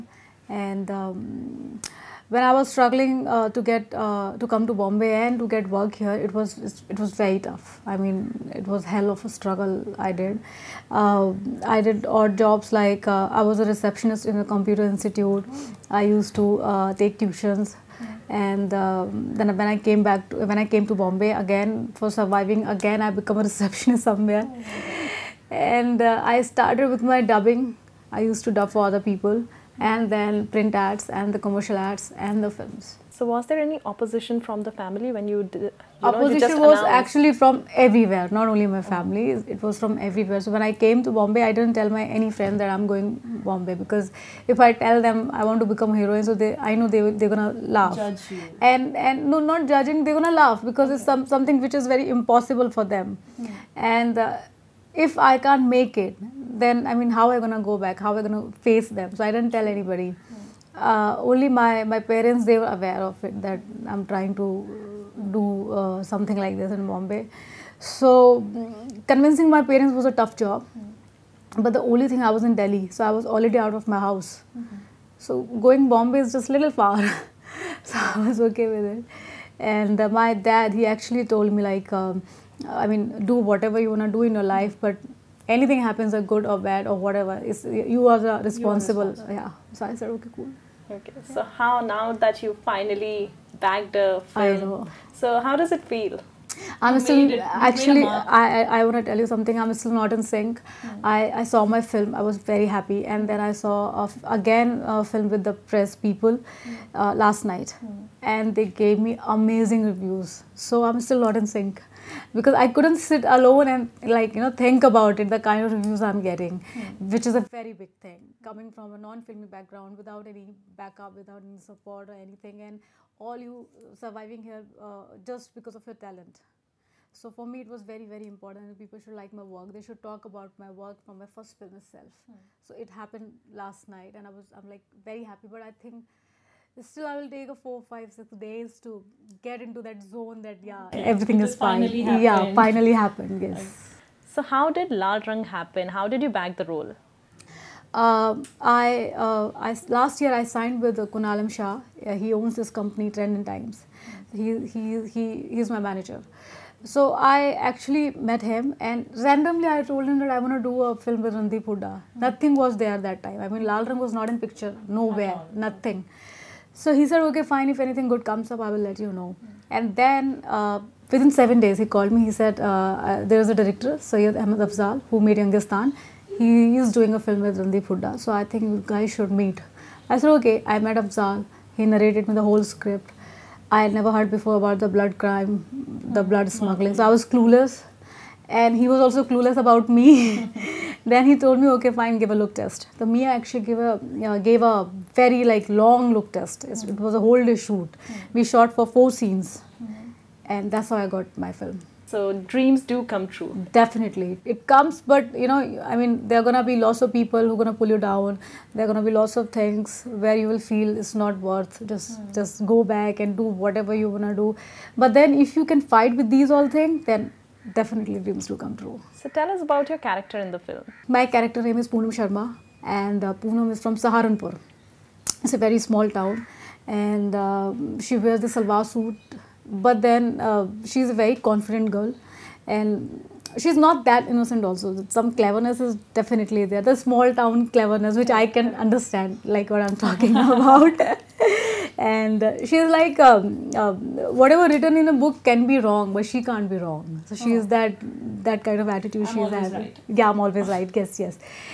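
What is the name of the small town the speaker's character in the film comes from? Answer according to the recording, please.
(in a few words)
Saharanpur.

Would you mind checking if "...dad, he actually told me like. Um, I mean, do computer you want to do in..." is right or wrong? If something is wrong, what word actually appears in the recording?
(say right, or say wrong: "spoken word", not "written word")
wrong: "whatever", not "computer".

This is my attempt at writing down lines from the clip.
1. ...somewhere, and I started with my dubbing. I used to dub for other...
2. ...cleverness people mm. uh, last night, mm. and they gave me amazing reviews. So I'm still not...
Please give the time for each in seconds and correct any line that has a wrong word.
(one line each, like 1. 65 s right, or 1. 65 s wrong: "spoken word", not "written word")
1. 24 s right
2. 105 s wrong: "press", not "cleverness".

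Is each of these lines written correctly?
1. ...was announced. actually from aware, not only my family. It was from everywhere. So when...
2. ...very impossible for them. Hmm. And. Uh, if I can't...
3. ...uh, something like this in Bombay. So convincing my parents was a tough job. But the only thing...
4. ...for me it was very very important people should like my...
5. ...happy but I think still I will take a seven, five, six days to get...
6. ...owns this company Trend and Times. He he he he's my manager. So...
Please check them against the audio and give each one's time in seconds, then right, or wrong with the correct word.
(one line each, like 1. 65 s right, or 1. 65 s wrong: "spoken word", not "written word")
1. 36 s wrong: "everywhere", not "aware"
2. 51 s right
3. 65 s right
4. 127 s right
5. 135 s wrong: "four", not "seven"
6. 152 s right.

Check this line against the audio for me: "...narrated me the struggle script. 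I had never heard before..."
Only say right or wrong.
wrong.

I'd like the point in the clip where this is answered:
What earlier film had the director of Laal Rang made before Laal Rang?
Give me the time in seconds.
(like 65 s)
175 s.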